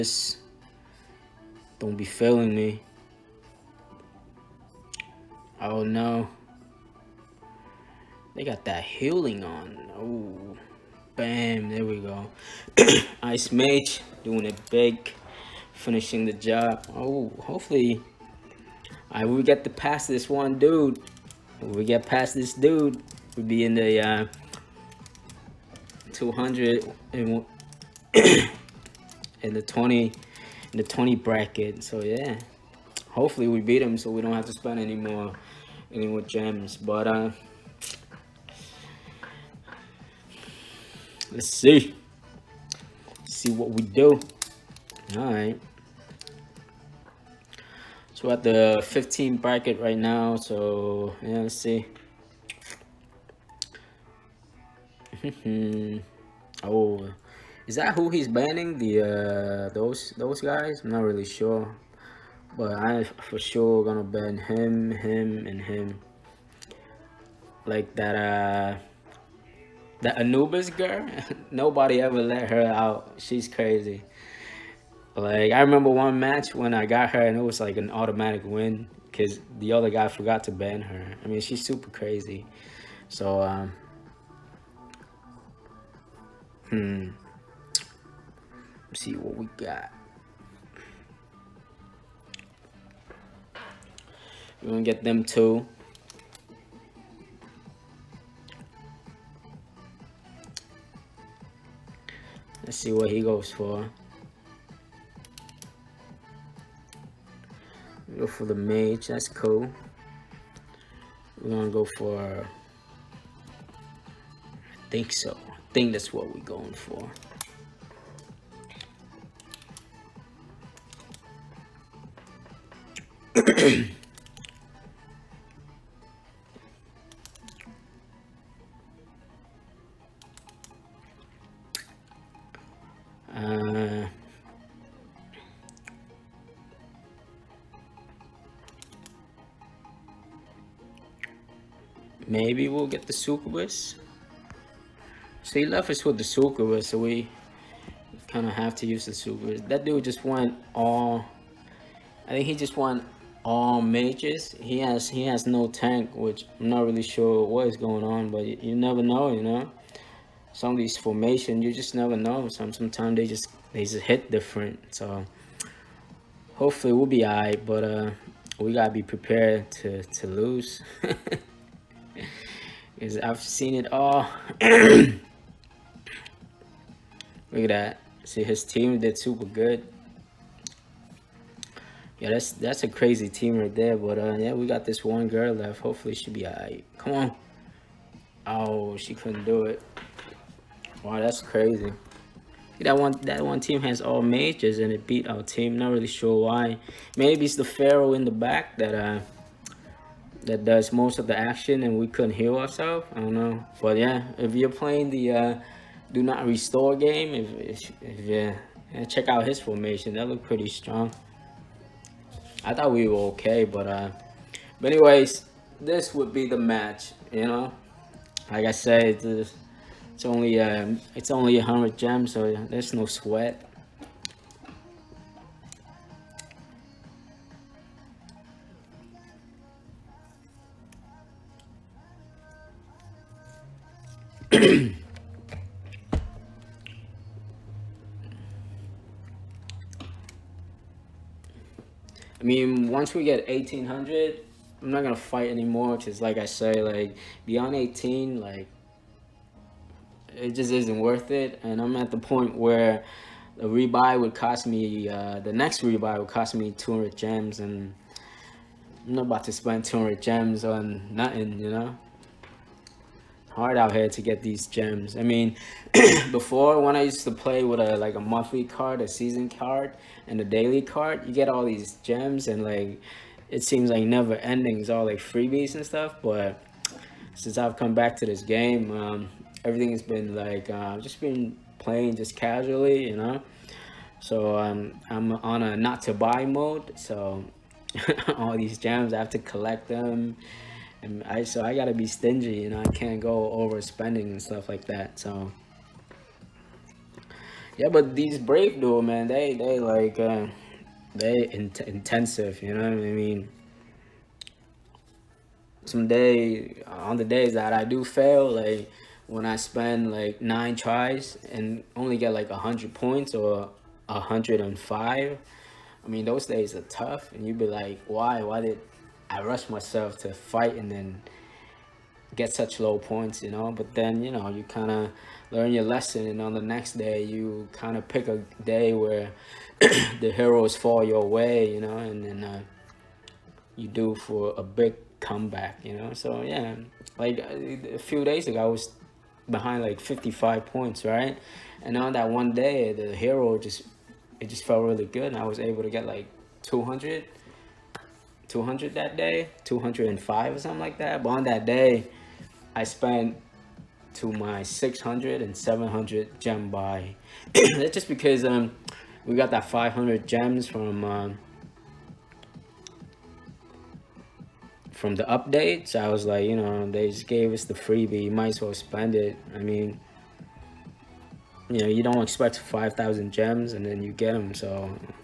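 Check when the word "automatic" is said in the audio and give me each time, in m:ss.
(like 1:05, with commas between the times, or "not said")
1:17.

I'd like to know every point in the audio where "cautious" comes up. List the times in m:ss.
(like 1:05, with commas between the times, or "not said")
not said.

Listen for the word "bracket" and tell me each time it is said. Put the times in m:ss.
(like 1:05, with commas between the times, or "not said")
0:31, 0:49.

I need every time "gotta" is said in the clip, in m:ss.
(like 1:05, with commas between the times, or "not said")
2:48, 4:51.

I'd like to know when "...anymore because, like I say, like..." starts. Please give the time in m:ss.
4:05.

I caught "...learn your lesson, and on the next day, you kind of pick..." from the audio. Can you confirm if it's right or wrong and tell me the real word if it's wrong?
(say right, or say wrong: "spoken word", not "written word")
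right.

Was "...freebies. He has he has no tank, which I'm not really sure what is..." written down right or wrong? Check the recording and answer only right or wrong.
wrong.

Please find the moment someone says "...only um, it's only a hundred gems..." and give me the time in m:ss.
3:40.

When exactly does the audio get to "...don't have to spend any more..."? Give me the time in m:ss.
0:34.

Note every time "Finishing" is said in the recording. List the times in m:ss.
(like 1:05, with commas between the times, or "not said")
0:15.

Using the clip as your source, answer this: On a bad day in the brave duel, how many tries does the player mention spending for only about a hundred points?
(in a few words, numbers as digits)
9.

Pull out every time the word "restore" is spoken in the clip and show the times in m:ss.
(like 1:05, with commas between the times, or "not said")
3:26.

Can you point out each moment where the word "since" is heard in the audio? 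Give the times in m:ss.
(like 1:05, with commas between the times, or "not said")
4:37.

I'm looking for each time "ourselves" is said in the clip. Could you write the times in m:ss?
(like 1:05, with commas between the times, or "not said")
3:22.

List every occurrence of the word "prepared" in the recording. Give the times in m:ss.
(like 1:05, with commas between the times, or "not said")
2:49.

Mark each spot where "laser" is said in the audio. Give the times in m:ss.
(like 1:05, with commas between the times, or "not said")
not said.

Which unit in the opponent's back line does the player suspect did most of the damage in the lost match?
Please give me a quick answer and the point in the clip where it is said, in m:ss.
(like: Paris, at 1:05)
Pharaoh, at 3:17.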